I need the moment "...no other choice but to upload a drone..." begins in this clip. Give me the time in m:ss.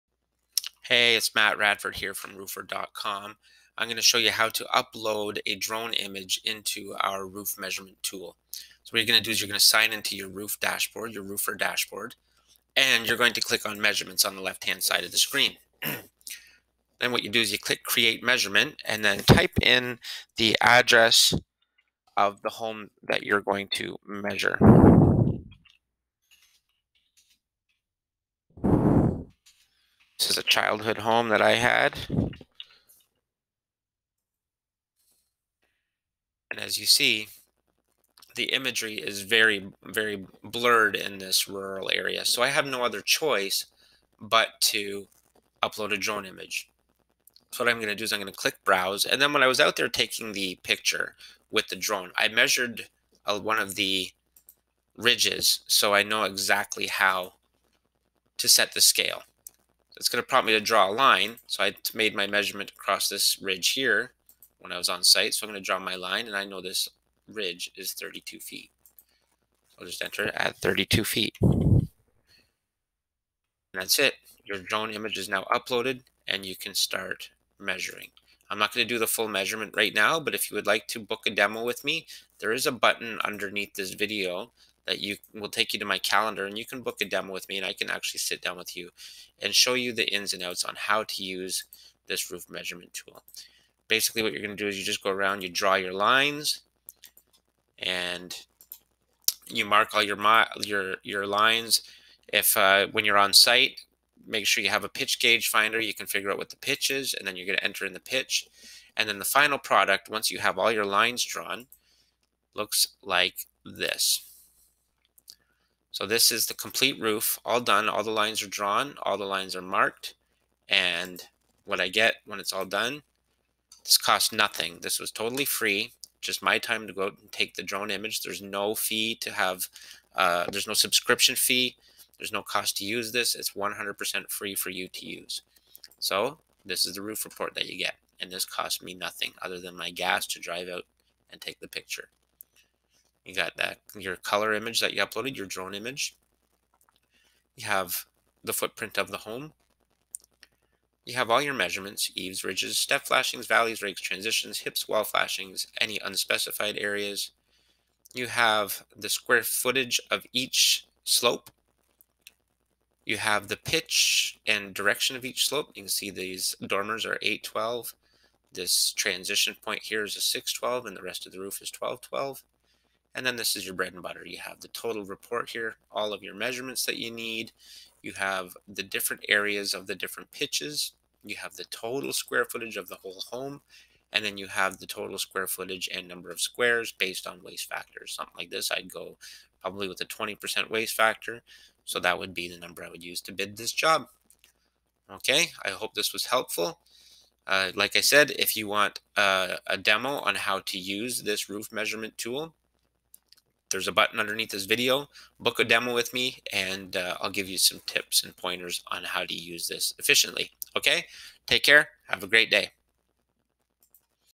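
0:42.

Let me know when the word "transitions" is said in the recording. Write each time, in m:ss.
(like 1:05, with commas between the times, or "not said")
2:34, 2:48.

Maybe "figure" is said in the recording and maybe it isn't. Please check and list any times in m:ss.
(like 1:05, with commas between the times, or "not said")
1:46.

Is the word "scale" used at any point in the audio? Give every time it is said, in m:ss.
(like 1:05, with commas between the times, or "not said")
0:58.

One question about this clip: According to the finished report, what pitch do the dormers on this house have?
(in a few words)
8/12.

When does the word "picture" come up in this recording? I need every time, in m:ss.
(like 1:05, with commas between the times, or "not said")
0:50, 2:21.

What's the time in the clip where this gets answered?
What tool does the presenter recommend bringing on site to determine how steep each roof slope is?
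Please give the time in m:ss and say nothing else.
1:44.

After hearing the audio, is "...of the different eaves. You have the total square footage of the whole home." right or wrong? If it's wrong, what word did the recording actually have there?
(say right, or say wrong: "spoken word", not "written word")
wrong: "pitches", not "eaves".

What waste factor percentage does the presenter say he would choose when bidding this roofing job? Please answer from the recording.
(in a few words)
20%.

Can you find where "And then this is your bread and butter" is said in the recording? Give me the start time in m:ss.
2:53.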